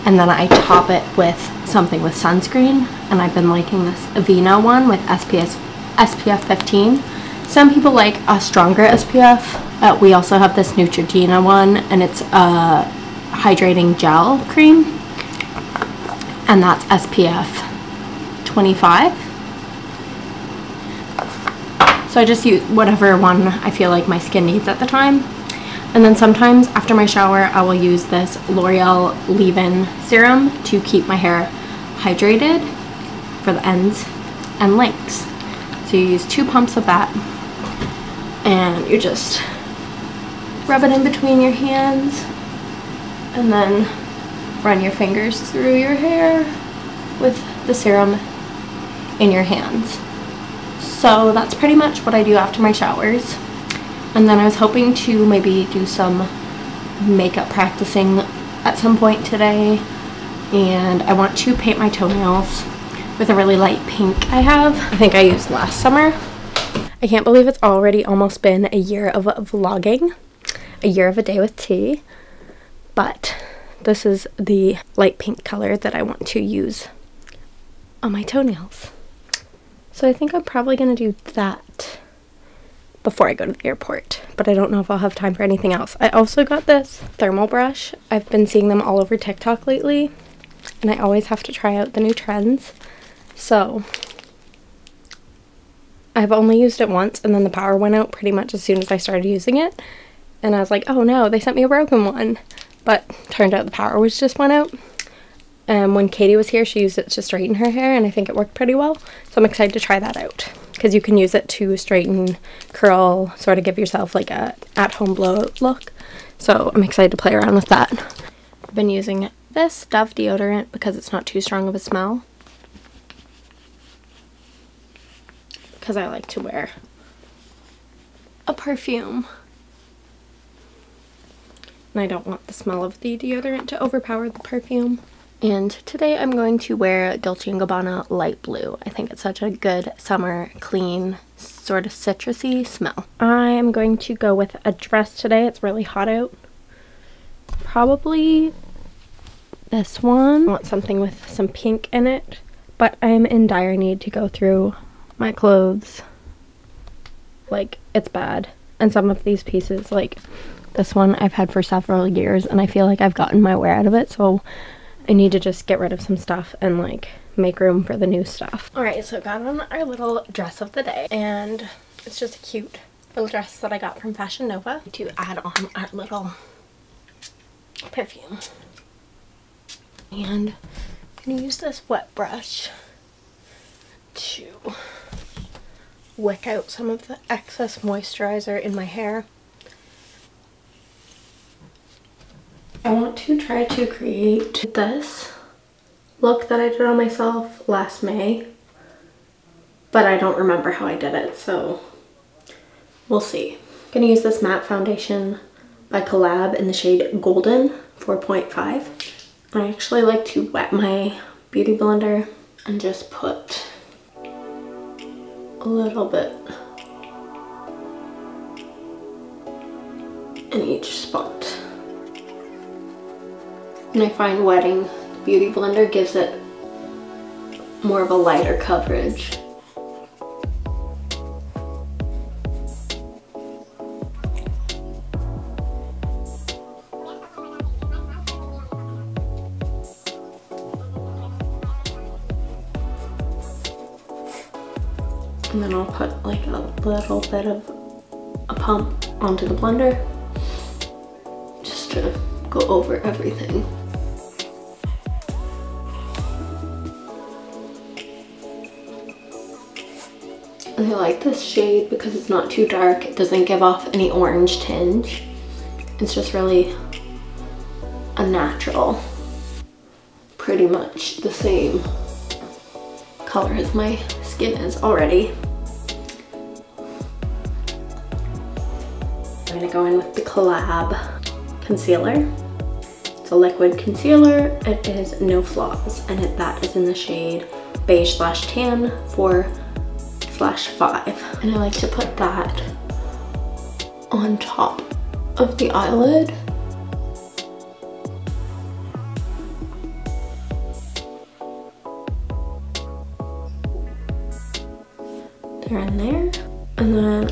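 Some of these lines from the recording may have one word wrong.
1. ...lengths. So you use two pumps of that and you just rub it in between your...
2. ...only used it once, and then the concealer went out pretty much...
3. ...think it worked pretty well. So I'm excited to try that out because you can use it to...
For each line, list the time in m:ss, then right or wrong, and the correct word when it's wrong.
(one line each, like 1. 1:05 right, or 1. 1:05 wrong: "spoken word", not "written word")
1. 0:34 right
2. 1:36 wrong: "power", not "concealer"
3. 1:48 right.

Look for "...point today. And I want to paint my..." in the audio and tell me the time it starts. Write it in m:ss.
0:58.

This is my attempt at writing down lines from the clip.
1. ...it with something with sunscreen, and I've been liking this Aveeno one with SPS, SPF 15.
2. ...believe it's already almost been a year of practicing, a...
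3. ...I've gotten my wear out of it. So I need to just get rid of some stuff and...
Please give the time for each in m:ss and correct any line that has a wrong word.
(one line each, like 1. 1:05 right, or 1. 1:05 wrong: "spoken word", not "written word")
1. 0:00 right
2. 1:07 wrong: "vlogging", not "practicing"
3. 2:43 right.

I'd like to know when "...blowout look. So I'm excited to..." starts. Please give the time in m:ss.
1:55.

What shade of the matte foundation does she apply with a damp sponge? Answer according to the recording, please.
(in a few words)
Golden 4.5.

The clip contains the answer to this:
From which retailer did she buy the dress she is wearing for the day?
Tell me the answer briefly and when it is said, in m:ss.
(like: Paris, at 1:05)
Fashion Nova, at 2:54.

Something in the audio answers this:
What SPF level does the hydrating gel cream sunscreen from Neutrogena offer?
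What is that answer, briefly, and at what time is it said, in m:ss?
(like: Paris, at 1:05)
SPF 25, at 0:16.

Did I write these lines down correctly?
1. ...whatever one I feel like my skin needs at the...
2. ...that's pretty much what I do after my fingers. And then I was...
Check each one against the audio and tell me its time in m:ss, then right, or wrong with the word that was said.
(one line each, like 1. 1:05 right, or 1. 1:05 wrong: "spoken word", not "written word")
1. 0:22 right
2. 0:51 wrong: "showers", not "fingers".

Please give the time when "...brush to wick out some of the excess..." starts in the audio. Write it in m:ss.
3:02.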